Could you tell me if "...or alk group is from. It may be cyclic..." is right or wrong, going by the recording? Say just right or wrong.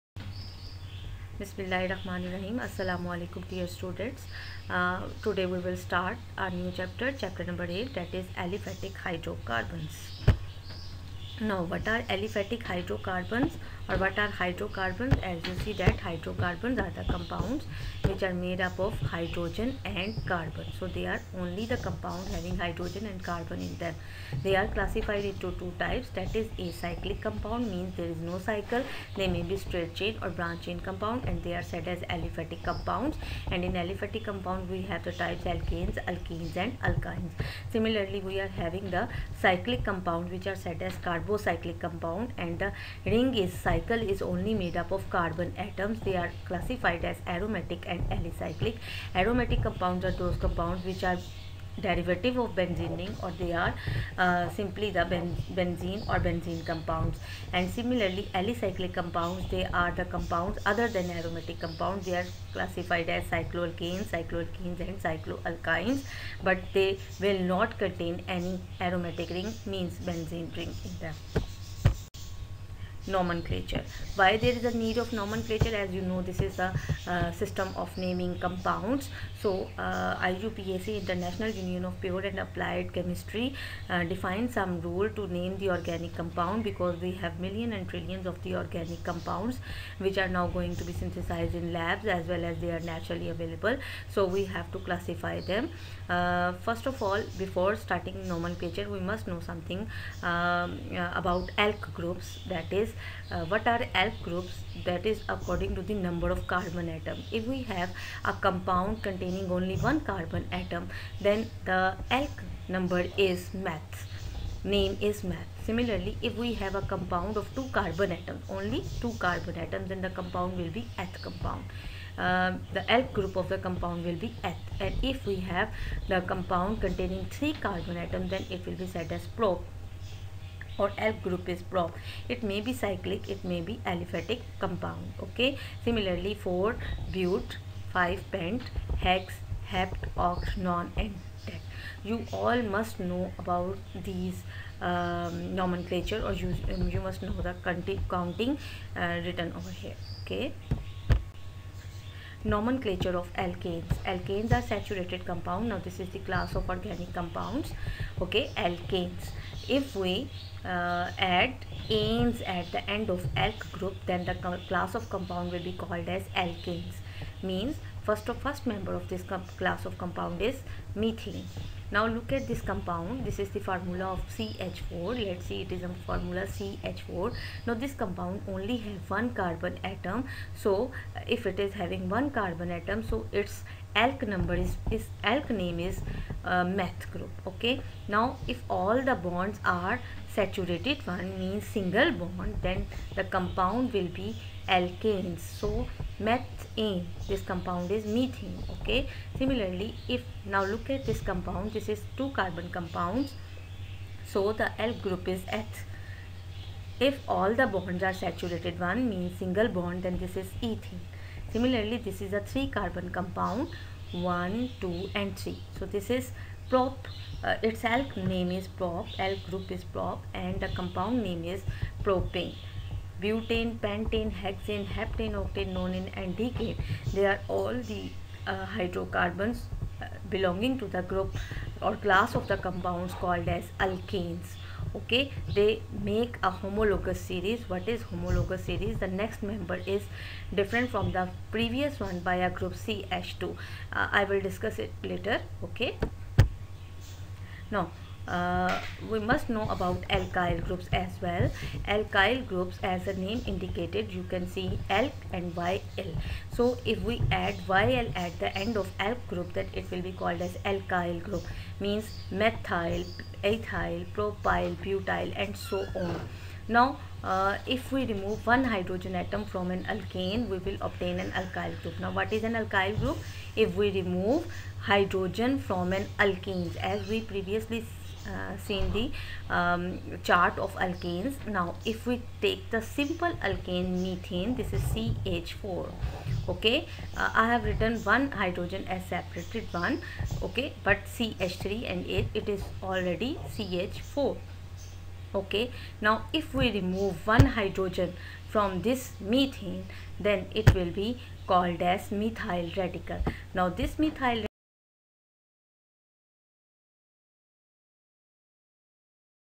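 right.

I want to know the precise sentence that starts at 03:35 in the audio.
So this is prop, uh, its alk name is prop, alk group is prop and the compound name is propane.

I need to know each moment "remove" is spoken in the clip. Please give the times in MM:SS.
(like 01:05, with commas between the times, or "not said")
04:28, 04:33, 04:56.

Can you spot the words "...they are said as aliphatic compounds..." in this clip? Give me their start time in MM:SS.
00:31.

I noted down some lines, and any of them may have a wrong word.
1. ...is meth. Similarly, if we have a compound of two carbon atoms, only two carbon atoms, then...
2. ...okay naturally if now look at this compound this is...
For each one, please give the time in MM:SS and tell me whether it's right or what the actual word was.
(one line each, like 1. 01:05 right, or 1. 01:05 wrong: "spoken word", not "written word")
1. 01:55 right
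2. 03:18 wrong: "similarly", not "naturally".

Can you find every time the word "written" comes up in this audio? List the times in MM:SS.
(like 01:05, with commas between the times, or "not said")
02:29, 04:47.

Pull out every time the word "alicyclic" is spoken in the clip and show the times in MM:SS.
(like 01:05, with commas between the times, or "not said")
00:48, 00:58.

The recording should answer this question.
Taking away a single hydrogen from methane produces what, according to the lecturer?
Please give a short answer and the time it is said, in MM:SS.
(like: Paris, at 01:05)
methyl radical, at 05:02.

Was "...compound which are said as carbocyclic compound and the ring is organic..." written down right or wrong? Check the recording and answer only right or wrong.
wrong.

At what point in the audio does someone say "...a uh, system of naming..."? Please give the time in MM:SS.
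01:16.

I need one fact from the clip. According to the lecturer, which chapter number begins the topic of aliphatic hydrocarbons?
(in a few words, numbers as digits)
8.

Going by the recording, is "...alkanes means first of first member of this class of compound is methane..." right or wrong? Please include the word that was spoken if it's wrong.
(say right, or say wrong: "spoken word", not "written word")
right.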